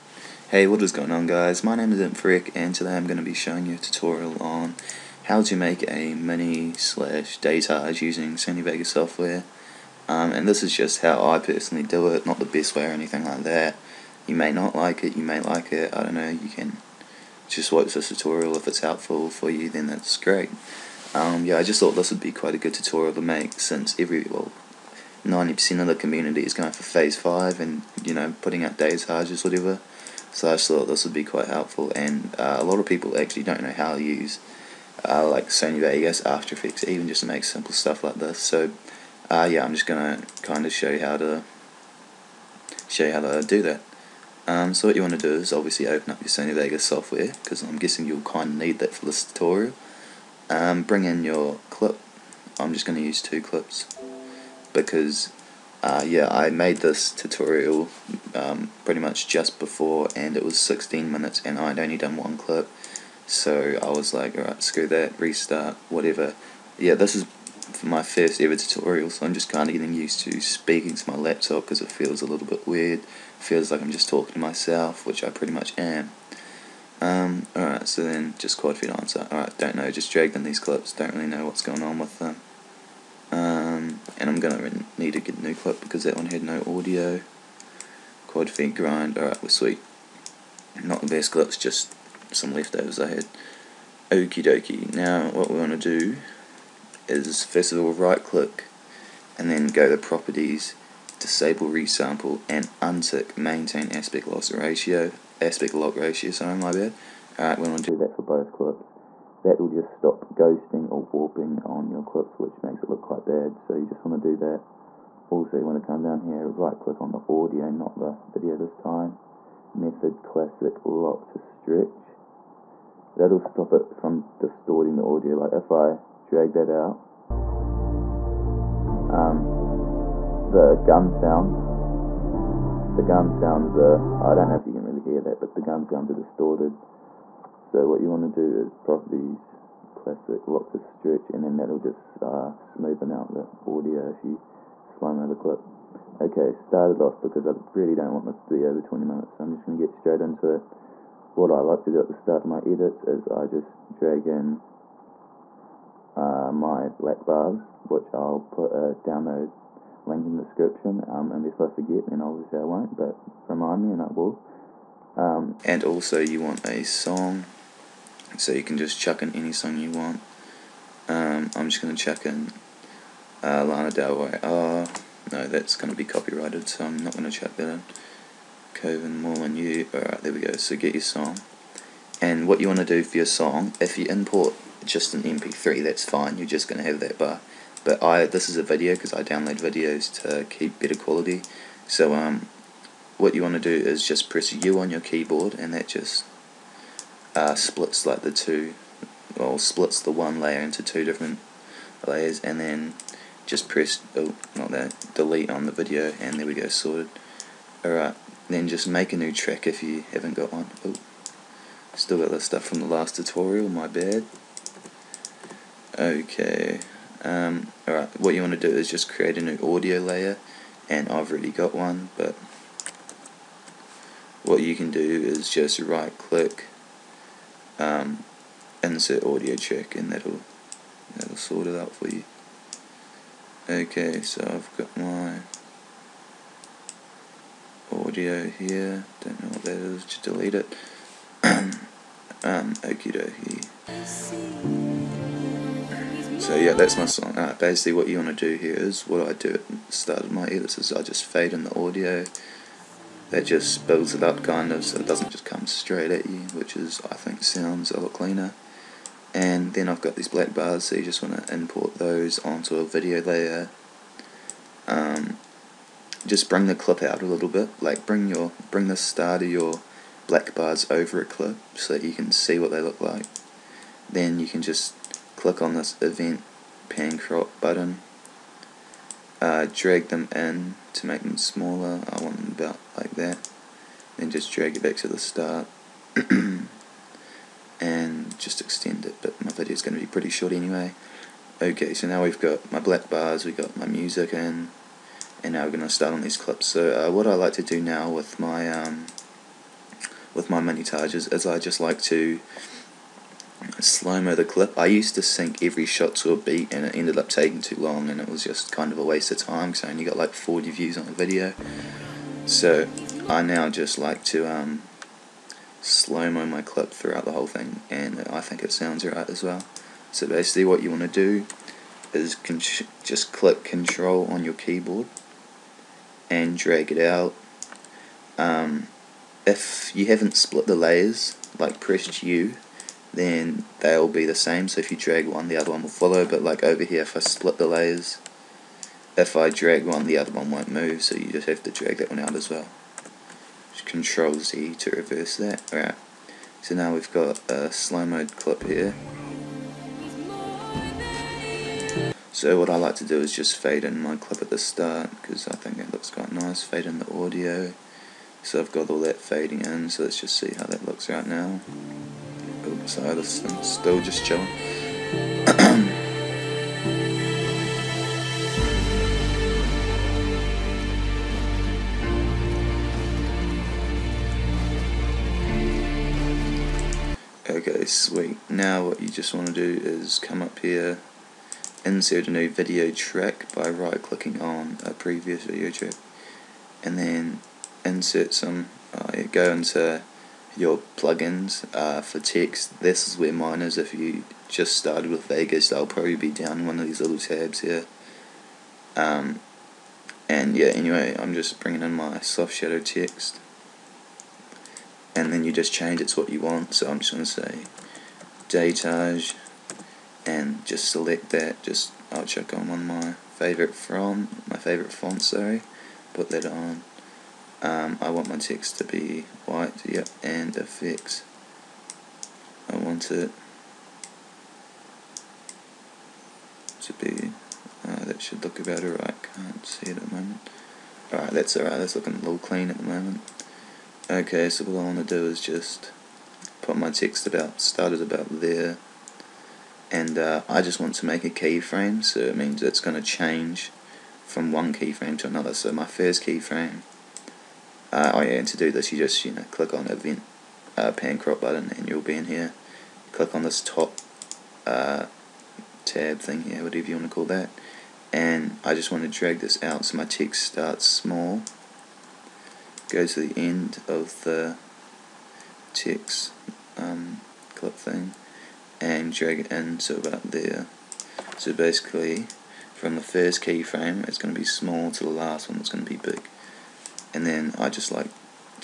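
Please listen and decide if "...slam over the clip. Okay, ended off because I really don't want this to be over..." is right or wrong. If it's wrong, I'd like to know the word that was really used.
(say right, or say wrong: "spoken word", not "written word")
wrong: "started", not "ended".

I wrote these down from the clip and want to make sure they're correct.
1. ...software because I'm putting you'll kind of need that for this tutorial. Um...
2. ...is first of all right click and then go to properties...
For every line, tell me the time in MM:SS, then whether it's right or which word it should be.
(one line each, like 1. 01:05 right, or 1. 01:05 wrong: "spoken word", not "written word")
1. 00:46 wrong: "guessing", not "putting"
2. 01:37 right.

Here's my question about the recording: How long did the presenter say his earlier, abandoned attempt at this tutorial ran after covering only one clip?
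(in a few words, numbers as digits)
16 minutes.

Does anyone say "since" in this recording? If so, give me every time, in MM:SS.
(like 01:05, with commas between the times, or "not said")
00:23.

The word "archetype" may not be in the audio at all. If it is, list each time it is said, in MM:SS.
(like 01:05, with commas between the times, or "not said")
not said.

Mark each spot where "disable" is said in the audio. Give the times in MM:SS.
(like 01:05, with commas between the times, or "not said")
01:41.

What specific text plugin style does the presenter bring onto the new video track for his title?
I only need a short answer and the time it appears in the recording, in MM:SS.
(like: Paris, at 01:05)
soft shadow text, at 06:42.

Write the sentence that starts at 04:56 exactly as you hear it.
So uh, what I like to do now with my um, with my montages is I just like to slow the clip.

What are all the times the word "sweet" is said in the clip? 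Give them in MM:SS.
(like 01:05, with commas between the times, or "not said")
01:29, 06:17.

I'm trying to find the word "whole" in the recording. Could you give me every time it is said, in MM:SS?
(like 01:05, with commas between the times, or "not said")
05:17.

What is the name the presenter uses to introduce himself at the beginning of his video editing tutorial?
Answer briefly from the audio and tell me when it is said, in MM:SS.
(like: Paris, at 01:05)
Imfrick, at 00:01.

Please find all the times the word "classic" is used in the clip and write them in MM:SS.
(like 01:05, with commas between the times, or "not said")
02:00, 02:19.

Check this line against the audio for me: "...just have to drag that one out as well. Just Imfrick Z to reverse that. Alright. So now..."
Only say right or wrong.
wrong.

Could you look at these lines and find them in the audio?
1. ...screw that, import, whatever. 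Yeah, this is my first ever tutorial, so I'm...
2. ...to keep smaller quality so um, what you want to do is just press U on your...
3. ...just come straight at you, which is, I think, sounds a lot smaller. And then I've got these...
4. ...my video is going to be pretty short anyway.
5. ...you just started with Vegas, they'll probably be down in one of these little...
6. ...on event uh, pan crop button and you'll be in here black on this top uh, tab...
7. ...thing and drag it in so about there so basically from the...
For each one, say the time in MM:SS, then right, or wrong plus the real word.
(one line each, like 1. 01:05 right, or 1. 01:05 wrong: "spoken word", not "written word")
1. 01:04 wrong: "restart", not "import"
2. 03:10 wrong: "better", not "smaller"
3. 04:15 wrong: "cleaner", not "smaller"
4. 04:49 right
5. 06:33 right
6. 07:29 wrong: "click", not "black"
7. 07:47 right.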